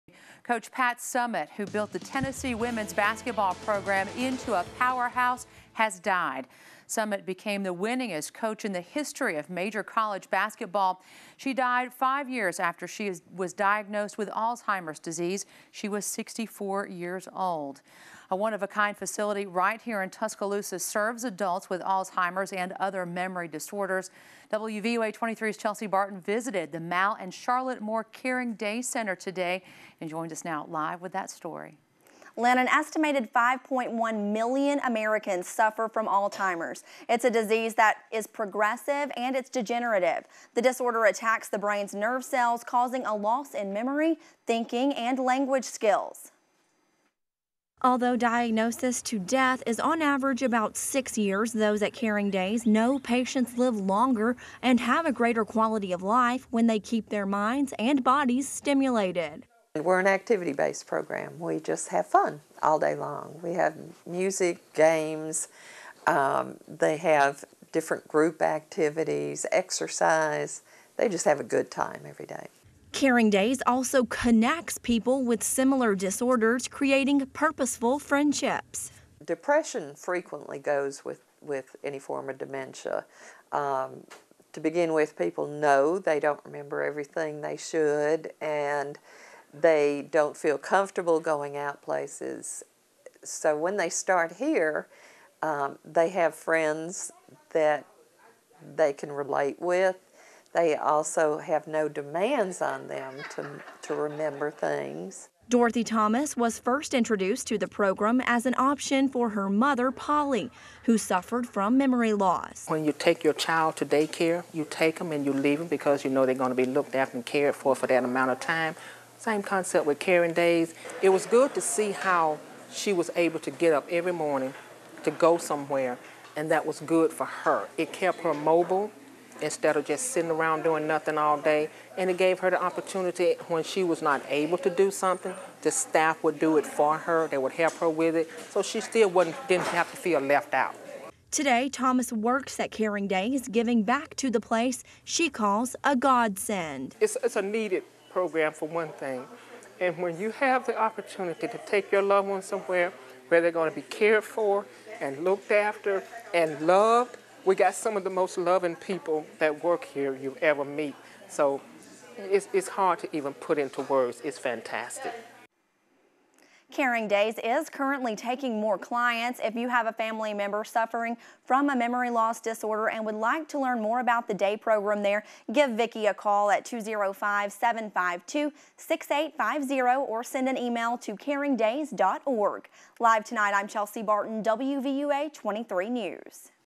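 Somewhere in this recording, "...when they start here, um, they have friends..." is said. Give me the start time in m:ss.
1:33.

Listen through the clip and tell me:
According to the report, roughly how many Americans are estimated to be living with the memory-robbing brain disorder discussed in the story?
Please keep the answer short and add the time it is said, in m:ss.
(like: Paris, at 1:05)
5.1 million, at 0:33.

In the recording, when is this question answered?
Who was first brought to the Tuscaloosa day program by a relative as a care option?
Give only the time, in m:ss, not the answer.
1:45.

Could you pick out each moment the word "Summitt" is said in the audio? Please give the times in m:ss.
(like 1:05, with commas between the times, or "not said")
0:00, 0:06.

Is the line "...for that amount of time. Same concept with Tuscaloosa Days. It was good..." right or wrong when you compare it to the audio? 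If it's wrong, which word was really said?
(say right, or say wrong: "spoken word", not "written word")
wrong: "Caring", not "Tuscaloosa".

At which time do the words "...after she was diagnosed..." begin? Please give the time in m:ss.
0:12.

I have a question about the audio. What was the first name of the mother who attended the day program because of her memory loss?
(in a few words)
Polly.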